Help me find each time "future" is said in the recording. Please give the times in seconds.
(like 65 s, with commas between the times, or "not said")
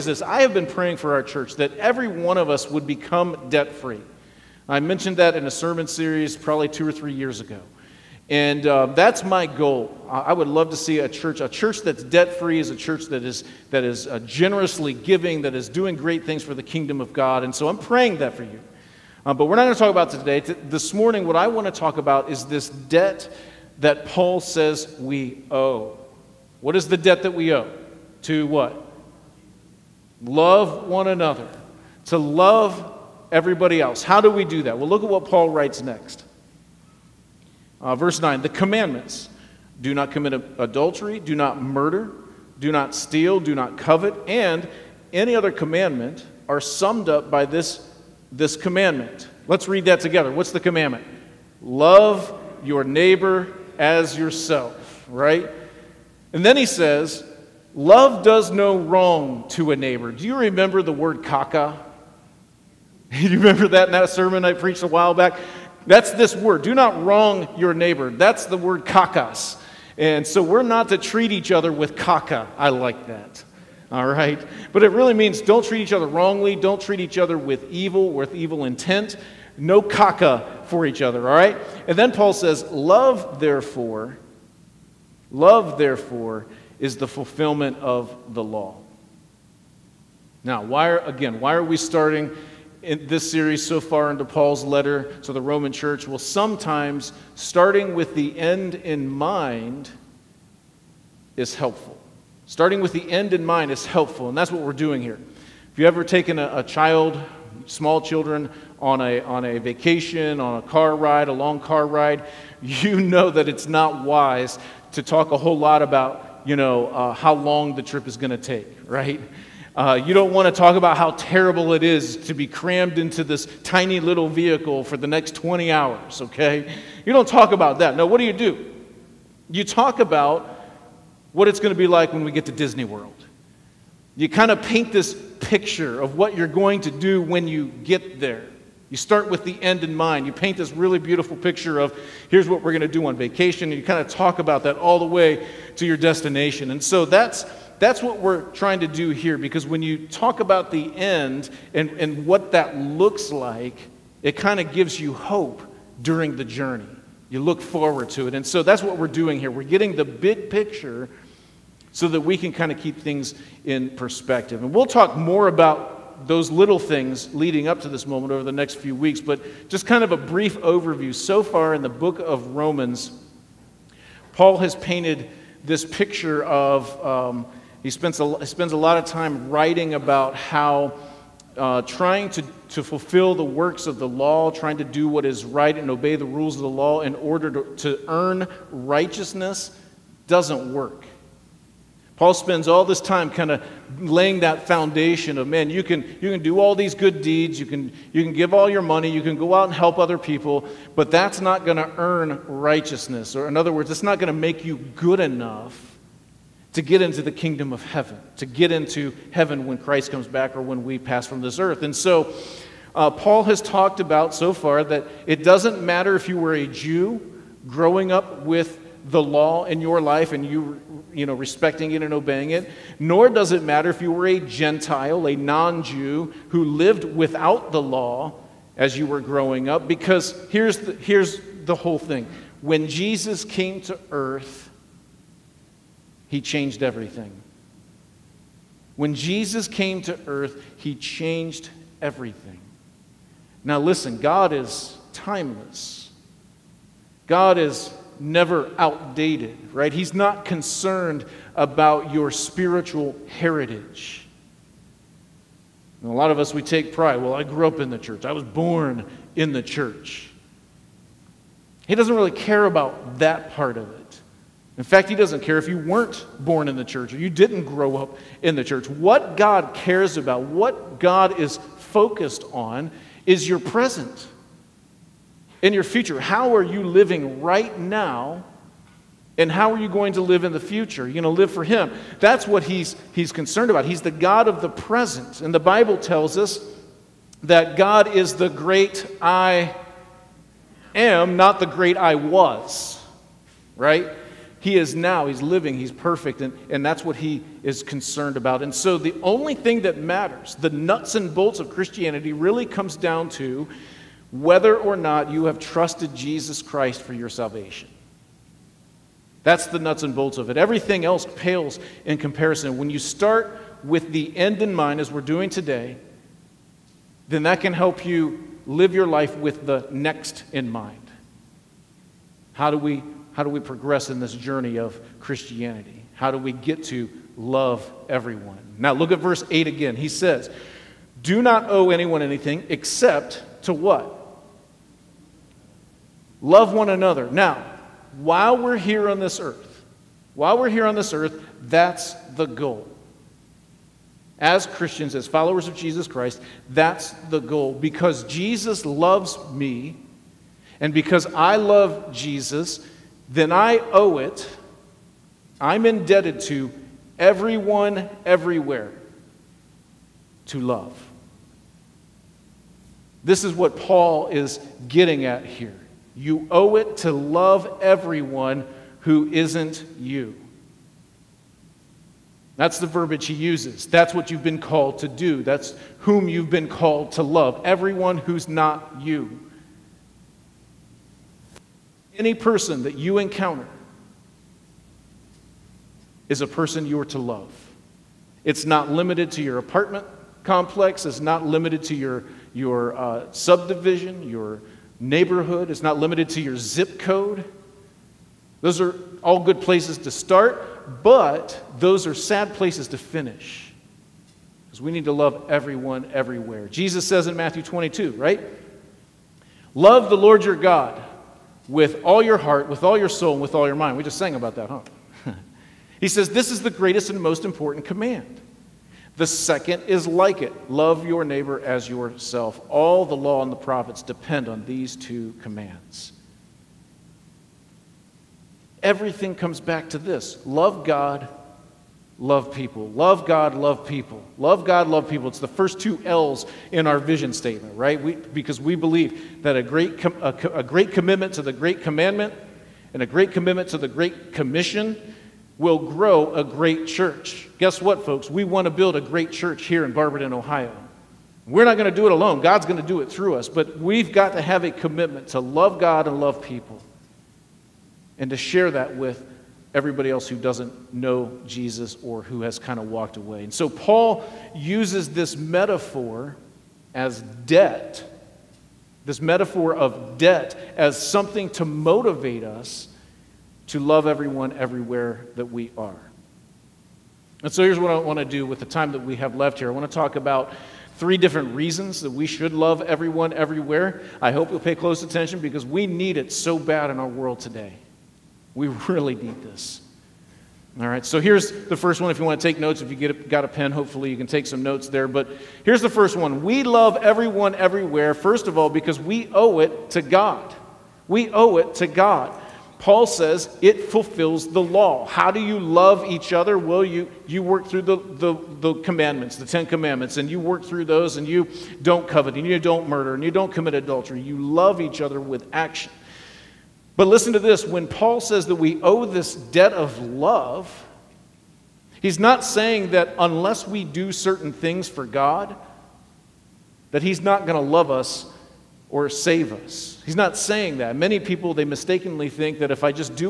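275 s, 280 s.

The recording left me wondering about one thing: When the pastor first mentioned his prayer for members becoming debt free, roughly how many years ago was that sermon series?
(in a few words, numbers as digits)
2 or 3 years.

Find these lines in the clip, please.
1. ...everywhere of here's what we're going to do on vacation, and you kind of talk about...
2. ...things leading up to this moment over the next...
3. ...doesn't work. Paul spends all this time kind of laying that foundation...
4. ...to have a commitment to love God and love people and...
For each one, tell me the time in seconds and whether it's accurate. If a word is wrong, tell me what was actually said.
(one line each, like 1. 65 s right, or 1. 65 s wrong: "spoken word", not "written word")
1. 141 s wrong: "picture", not "everywhere"
2. 166 s right
3. 190 s right
4. 454 s right.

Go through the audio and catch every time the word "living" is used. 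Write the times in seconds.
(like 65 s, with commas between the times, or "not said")
276 s, 295 s.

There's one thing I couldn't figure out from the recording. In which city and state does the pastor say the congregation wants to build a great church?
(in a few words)
Barberton, Ohio.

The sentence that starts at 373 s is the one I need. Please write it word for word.
That's what you've been called to do.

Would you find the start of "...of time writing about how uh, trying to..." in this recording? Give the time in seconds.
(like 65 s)
178 s.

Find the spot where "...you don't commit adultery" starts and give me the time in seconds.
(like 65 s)
513 s.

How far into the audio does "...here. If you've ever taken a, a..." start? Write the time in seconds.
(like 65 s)
105 s.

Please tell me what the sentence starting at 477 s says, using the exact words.
And so here's what I want to do with the time that we have left here.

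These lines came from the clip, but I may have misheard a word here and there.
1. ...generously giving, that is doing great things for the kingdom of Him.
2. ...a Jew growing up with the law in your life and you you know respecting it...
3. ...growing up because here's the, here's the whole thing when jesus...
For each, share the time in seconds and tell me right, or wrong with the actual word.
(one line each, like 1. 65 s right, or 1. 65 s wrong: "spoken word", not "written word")
1. 14 s wrong: "God", not "Him"
2. 216 s right
3. 229 s right.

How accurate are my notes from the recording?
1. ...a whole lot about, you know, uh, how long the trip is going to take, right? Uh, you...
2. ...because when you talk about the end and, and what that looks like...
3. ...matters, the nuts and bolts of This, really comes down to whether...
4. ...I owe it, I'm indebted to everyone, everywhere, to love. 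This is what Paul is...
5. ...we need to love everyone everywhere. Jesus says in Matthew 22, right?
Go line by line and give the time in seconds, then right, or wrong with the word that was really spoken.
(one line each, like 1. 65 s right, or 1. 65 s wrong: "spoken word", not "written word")
1. 115 s right
2. 149 s right
3. 299 s wrong: "Christianity", not "This"
4. 353 s right
5. 404 s right.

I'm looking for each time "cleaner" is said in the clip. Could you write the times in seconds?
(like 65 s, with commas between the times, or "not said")
not said.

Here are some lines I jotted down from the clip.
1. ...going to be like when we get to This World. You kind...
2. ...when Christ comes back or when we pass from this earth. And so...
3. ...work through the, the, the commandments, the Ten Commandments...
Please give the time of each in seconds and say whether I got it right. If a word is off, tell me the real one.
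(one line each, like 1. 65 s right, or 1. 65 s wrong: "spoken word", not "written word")
1. 131 s wrong: "Disney", not "This"
2. 209 s right
3. 507 s right.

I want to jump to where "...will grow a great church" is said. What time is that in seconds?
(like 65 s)
445 s.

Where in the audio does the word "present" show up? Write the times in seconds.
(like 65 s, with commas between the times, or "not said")
273 s, 284 s.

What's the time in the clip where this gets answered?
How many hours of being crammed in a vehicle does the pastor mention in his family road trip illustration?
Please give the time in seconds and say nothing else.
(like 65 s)
125 s.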